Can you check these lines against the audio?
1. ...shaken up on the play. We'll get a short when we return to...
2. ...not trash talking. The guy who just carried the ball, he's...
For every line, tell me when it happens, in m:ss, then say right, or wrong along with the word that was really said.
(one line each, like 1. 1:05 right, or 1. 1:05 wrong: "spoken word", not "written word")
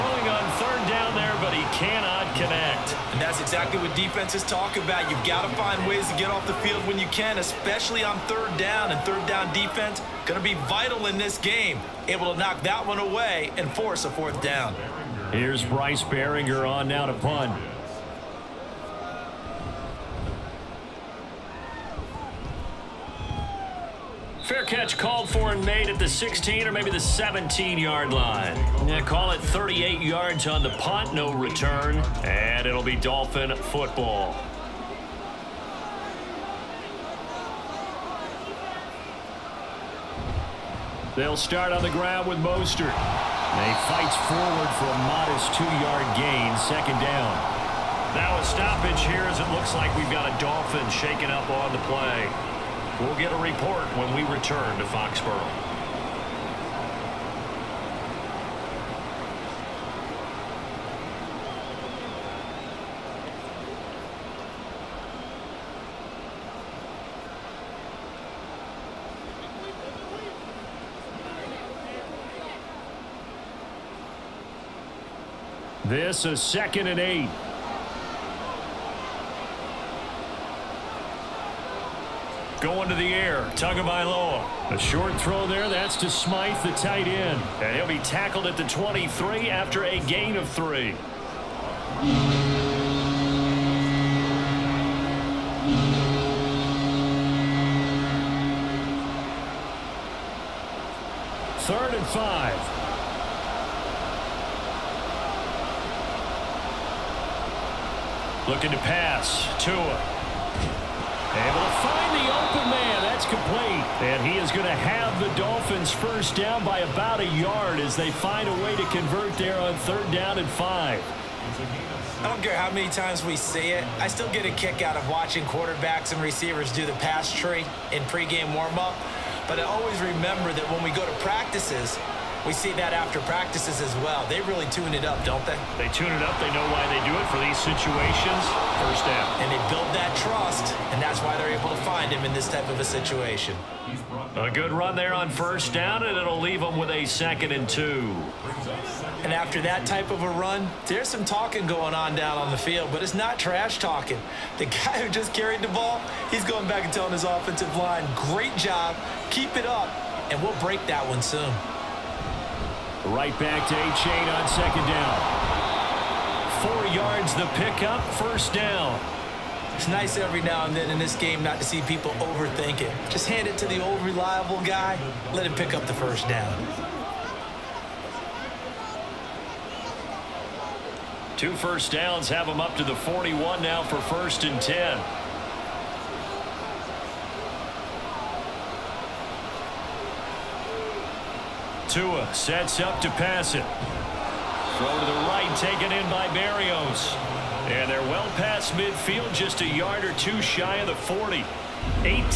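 1. 0:50 wrong: "report", not "short"
2. 2:33 right.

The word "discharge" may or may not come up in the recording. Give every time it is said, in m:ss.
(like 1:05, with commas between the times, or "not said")
not said.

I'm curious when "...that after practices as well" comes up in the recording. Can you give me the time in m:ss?
2:12.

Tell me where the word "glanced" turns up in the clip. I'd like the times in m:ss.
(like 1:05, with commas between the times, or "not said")
not said.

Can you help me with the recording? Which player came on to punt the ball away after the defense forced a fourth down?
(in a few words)
Bryce Baringer.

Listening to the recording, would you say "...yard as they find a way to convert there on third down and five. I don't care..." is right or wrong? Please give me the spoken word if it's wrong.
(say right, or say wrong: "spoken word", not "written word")
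right.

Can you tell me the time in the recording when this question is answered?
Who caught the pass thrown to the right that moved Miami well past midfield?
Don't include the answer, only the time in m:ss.
3:16.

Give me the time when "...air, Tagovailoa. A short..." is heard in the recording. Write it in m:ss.
1:23.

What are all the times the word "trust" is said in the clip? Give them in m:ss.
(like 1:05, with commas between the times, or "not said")
2:20.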